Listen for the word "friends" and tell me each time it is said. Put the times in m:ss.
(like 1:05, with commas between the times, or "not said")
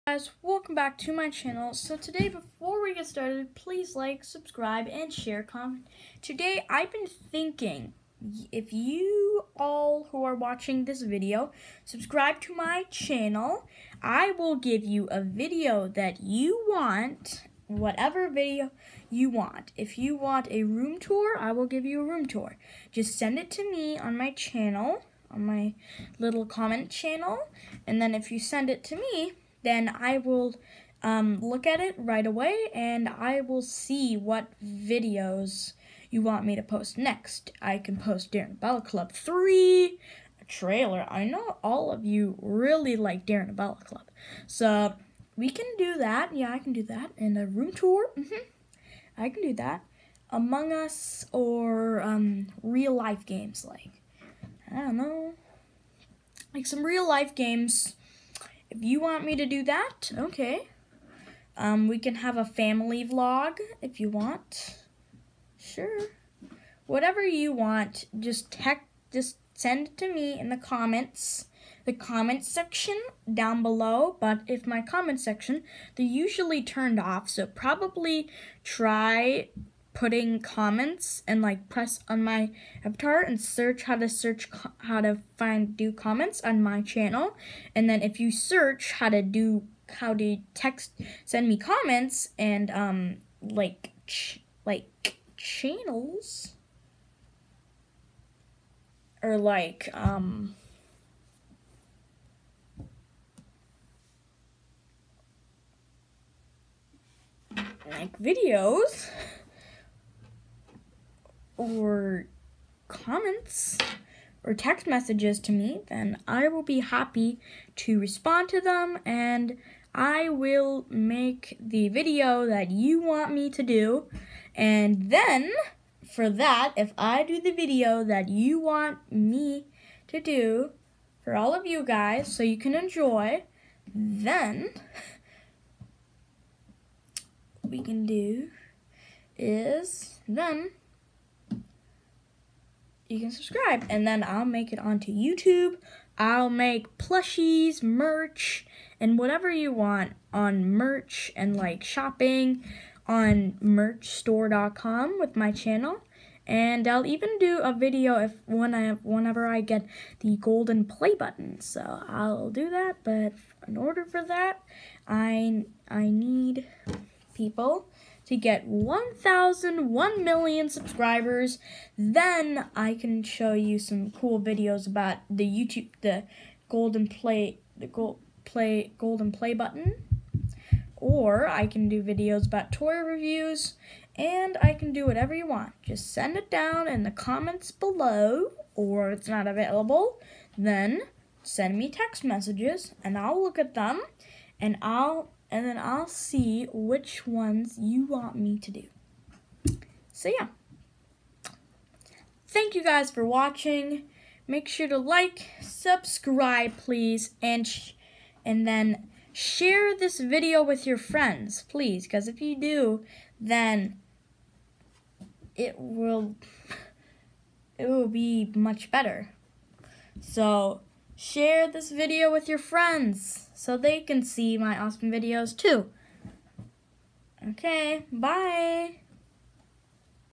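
3:30, 3:42.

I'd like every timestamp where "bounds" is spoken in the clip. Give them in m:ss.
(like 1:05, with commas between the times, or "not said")
not said.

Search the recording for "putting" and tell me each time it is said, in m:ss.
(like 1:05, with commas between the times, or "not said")
1:19.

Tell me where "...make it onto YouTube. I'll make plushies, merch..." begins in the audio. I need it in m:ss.
2:24.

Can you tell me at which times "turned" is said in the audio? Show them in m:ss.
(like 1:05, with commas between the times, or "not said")
1:16.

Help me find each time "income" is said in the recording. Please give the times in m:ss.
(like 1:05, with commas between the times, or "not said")
not said.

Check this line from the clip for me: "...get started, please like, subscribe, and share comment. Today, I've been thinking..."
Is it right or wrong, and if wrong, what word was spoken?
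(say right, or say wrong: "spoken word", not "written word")
right.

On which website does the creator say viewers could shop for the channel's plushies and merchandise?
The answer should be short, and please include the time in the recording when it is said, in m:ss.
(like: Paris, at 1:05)
merchstore.com, at 2:33.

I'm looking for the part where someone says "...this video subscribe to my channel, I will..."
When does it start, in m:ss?
0:10.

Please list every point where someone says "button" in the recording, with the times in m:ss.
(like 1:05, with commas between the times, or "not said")
2:41, 2:59.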